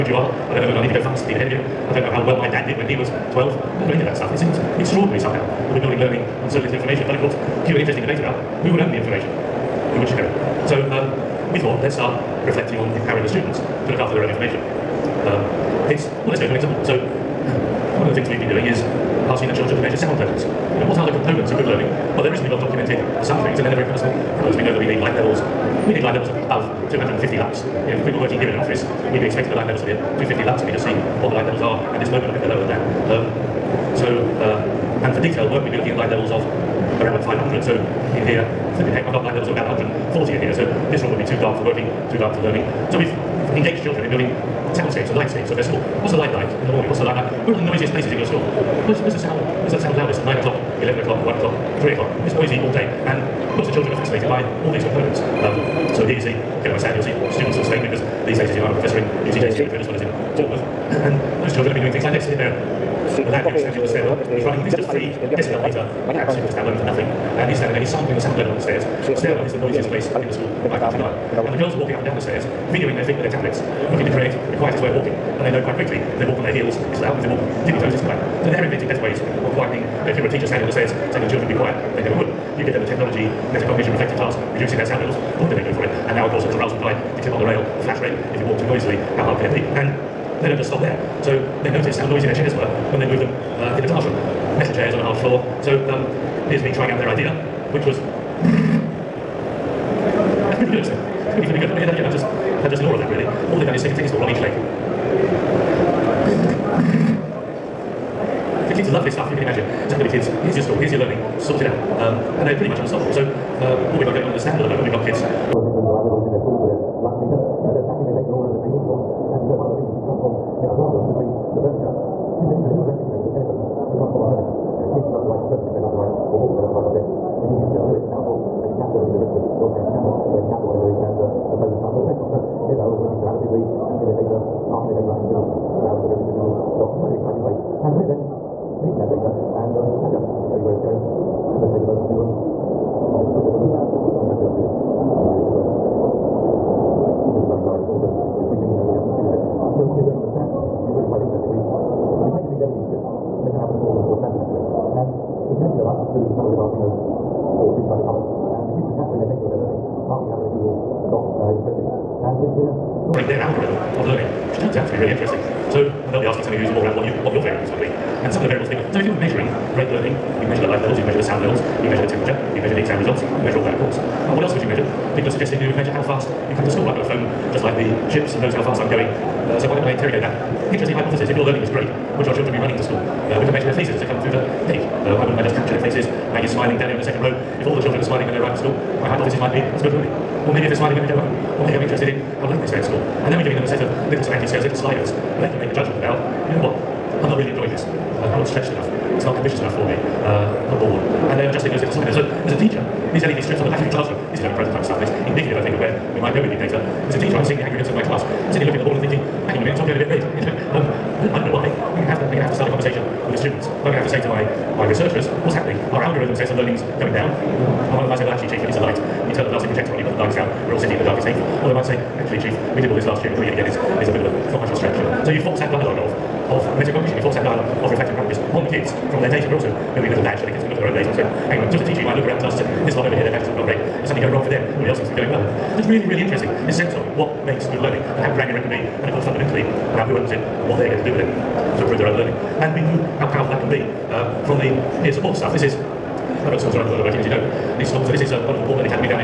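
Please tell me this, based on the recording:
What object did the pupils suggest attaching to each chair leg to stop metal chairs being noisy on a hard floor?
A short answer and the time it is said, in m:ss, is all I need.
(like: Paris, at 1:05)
A tennis ball, at 1:43.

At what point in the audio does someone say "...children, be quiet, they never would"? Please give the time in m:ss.
1:21.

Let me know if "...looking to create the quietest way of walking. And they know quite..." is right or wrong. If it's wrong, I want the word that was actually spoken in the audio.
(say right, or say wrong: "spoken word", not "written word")
right.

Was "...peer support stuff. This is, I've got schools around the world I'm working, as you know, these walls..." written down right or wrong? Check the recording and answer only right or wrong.
wrong.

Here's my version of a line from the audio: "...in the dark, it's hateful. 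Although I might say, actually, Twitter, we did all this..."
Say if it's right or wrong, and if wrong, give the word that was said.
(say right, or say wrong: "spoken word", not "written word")
wrong: "Chief", not "Twitter".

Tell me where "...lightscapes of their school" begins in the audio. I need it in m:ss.
0:45.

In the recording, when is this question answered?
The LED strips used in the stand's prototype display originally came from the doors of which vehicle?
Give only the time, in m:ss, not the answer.
2:34.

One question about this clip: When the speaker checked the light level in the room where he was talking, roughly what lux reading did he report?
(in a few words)
140.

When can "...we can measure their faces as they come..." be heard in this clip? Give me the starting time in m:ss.
3:03.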